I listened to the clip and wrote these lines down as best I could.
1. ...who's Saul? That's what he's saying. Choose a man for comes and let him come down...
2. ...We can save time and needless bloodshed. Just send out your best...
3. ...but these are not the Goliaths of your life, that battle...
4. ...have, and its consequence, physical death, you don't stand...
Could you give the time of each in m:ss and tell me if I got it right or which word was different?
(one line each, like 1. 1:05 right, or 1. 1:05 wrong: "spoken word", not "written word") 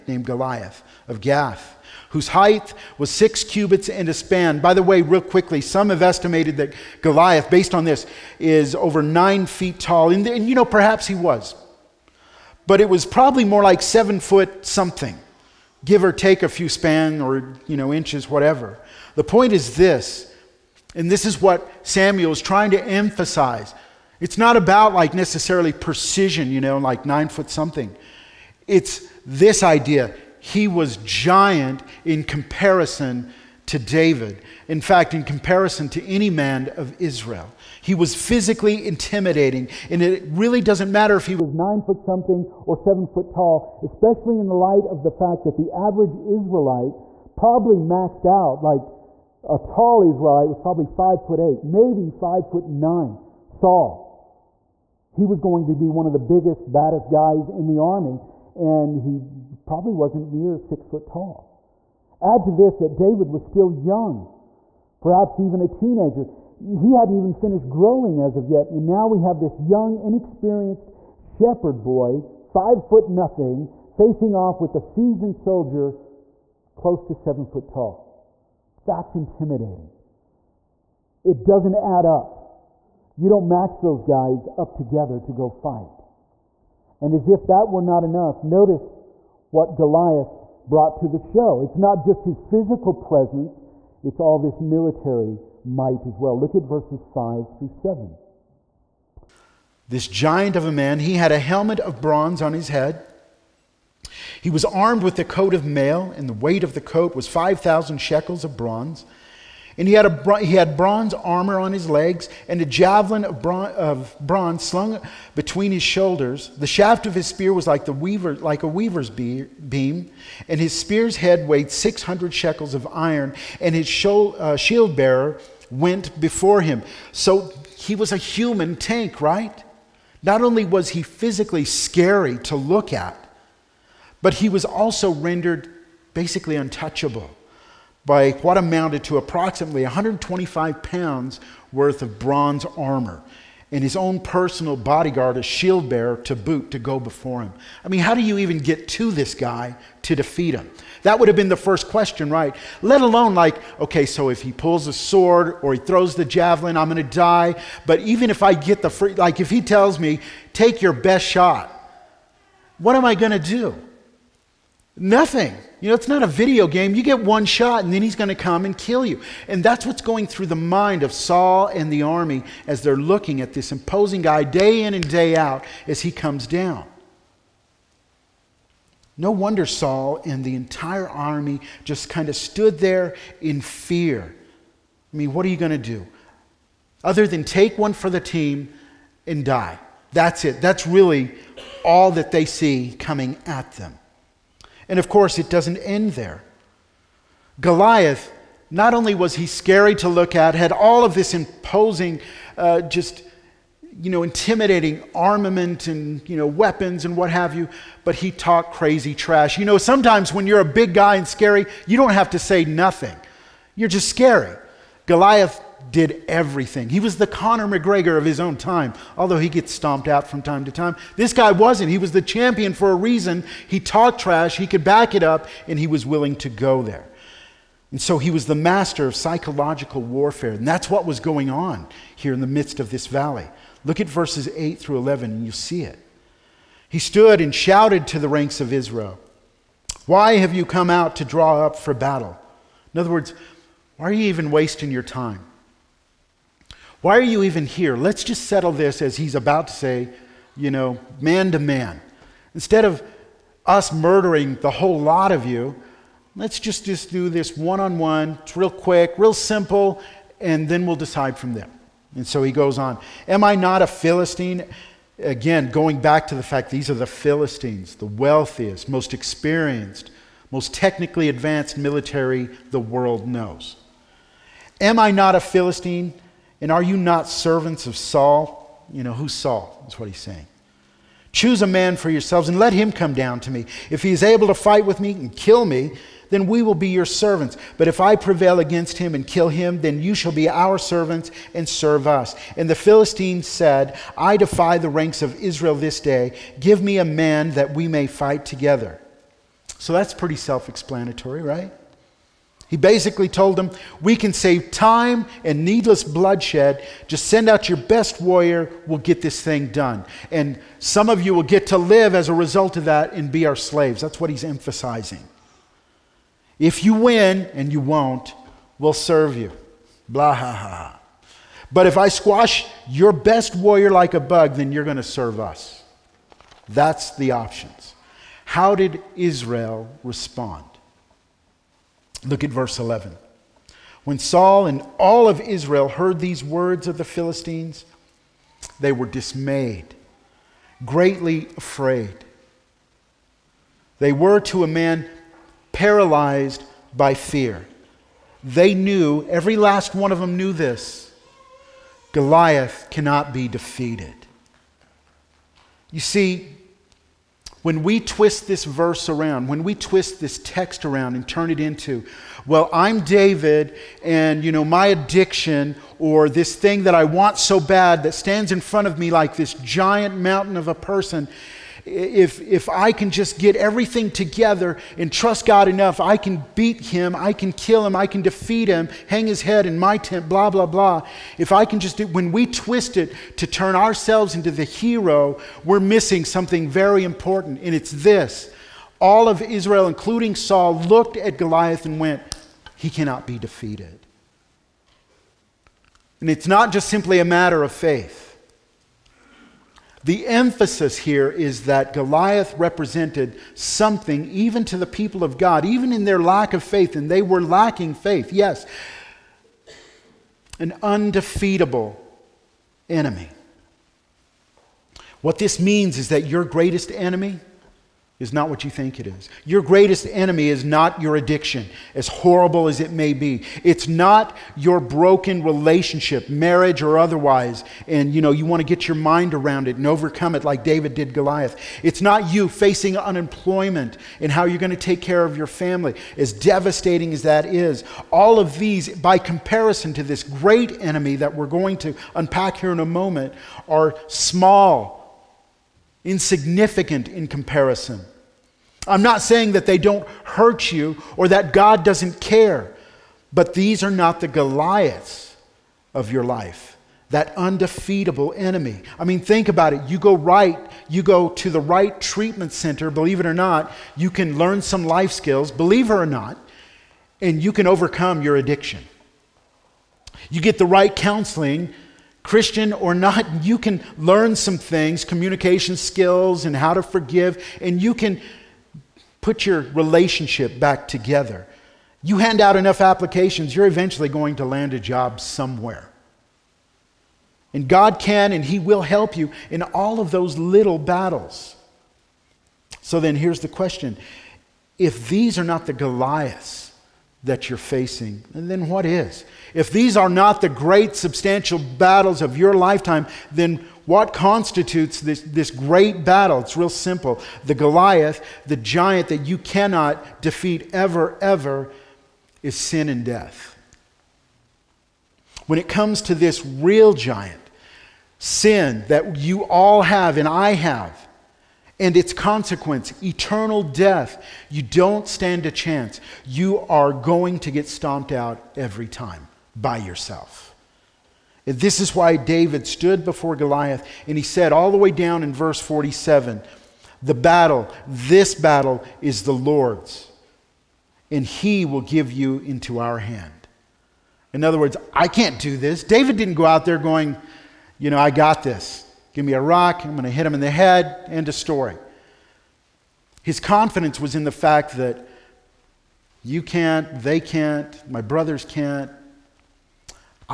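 1. 4:39 wrong: "yourselves", not "comes"
2. 5:04 right
3. 7:33 wrong: "undefeatable", not "battle"
4. 8:40 wrong: "eternal", not "physical".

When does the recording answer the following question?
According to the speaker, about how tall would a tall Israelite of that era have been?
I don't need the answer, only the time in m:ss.
0:50.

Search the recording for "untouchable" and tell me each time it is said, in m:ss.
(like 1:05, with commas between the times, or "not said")
2:16.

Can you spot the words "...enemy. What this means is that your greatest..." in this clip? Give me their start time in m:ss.
6:52.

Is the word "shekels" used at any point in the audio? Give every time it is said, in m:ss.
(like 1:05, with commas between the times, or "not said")
1:47, 2:02.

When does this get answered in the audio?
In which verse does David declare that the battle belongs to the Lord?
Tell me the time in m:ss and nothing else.
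8:55.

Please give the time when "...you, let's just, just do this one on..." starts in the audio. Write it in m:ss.
4:15.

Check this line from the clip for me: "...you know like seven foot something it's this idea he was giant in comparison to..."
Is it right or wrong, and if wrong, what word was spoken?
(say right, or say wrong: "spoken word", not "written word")
wrong: "nine", not "seven".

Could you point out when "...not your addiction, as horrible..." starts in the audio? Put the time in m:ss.
7:00.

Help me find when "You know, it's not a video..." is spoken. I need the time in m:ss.
2:45.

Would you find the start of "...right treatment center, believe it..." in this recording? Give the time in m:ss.
7:41.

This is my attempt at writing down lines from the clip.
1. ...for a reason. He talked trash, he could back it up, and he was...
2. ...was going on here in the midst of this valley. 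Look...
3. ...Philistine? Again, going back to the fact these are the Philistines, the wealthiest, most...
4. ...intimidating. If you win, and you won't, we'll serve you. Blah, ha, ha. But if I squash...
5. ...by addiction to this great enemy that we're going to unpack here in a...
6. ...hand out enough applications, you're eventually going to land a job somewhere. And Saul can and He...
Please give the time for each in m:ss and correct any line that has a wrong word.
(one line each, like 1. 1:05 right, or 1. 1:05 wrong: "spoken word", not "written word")
1. 3:42 right
2. 3:51 right
3. 4:23 right
4. 5:14 wrong: "emphasizing", not "intimidating"
5. 7:18 wrong: "comparison", not "addiction"
6. 8:02 wrong: "God", not "Saul".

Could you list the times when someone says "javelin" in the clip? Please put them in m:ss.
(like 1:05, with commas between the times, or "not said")
1:52, 2:36.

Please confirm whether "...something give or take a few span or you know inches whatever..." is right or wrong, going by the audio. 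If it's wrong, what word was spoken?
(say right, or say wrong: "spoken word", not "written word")
right.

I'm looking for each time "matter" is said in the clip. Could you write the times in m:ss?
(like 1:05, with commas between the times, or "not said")
0:40, 6:37.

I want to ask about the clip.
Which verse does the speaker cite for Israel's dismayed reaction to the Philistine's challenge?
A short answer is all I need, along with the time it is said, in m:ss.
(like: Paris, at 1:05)
Verse 11, at 5:32.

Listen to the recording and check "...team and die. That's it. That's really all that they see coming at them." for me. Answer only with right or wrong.
right.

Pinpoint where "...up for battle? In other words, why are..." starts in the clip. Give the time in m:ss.
4:01.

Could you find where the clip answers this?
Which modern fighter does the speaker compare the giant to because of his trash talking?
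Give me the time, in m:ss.
3:37.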